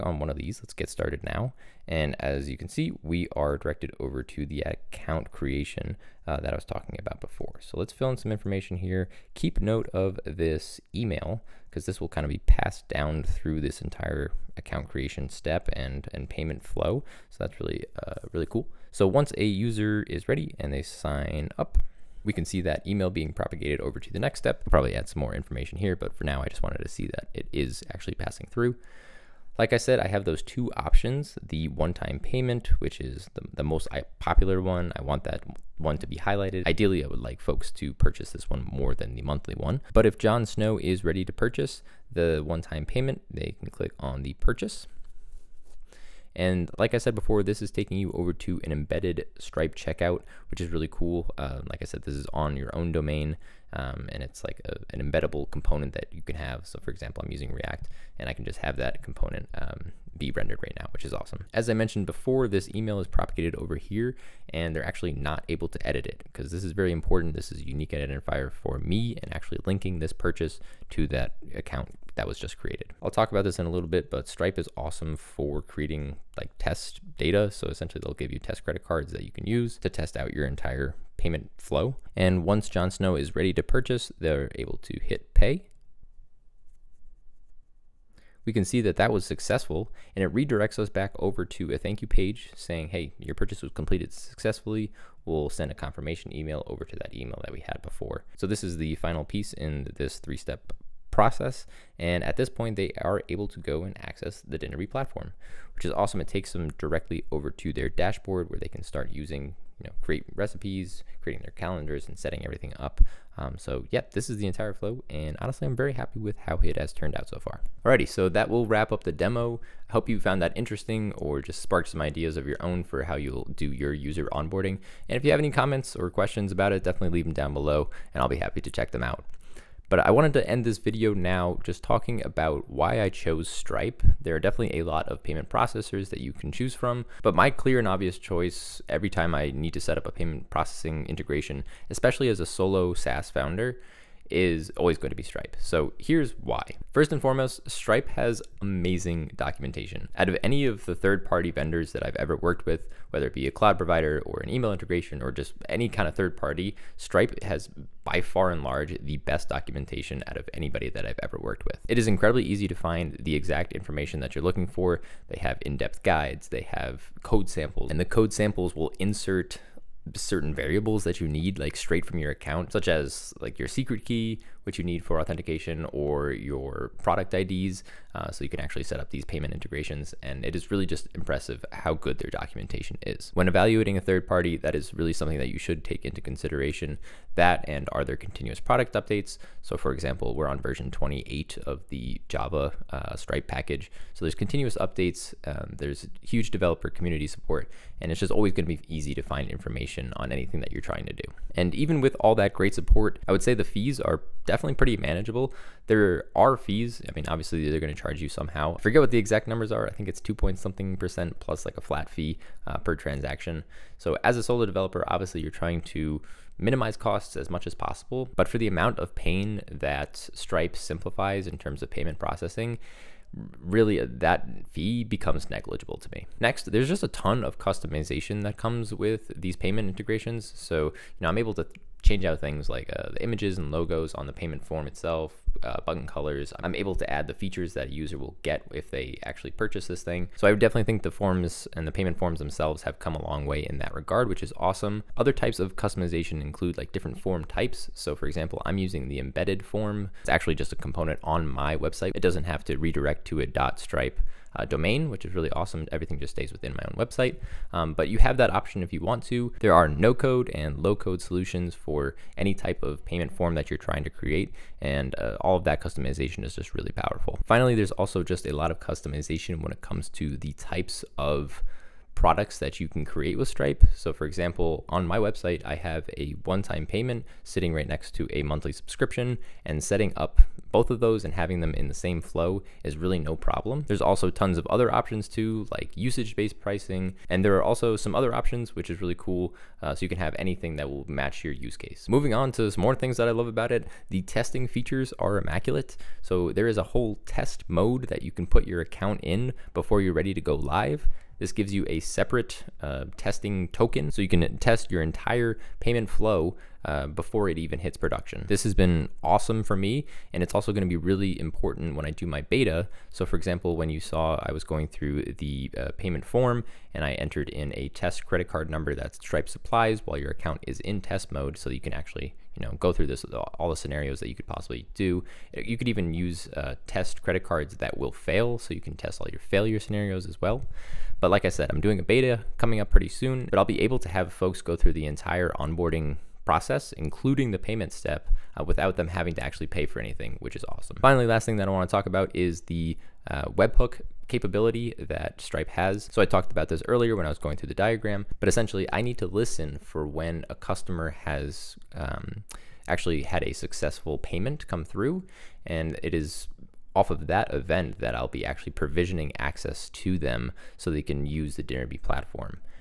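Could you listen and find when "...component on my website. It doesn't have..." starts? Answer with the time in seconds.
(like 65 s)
250 s.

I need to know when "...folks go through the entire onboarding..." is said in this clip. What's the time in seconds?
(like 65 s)
334 s.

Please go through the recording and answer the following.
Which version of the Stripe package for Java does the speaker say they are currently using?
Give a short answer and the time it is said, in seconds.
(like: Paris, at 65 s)
28, at 190 s.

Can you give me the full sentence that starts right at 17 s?
So that's really, uh, really cool.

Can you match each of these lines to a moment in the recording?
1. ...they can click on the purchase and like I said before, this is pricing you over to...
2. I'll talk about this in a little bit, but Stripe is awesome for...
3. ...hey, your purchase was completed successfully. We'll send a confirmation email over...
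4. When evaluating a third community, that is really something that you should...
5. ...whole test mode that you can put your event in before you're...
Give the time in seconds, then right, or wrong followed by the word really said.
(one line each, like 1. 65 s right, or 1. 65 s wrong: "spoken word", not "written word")
1. 43 s wrong: "taking", not "pricing"
2. 73 s right
3. 92 s right
4. 183 s wrong: "party", not "community"
5. 296 s wrong: "account", not "event".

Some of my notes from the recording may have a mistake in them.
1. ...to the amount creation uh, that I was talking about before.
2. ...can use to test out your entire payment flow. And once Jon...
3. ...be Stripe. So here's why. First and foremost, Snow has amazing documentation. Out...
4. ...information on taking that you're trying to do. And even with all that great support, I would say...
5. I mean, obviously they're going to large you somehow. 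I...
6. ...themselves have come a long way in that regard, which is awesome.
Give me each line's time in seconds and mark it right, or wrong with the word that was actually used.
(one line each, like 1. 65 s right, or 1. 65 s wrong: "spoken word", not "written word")
1. 4 s wrong: "account", not "amount"
2. 79 s right
3. 145 s wrong: "Stripe", not "Snow"
4. 199 s wrong: "anything", not "taking"
5. 207 s wrong: "charge", not "large"
6. 242 s right.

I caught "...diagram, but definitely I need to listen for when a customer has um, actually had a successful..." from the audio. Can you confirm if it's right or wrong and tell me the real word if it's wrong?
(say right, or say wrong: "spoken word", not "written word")
wrong: "essentially", not "definitely".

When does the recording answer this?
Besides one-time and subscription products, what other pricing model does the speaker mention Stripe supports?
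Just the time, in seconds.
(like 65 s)
285 s.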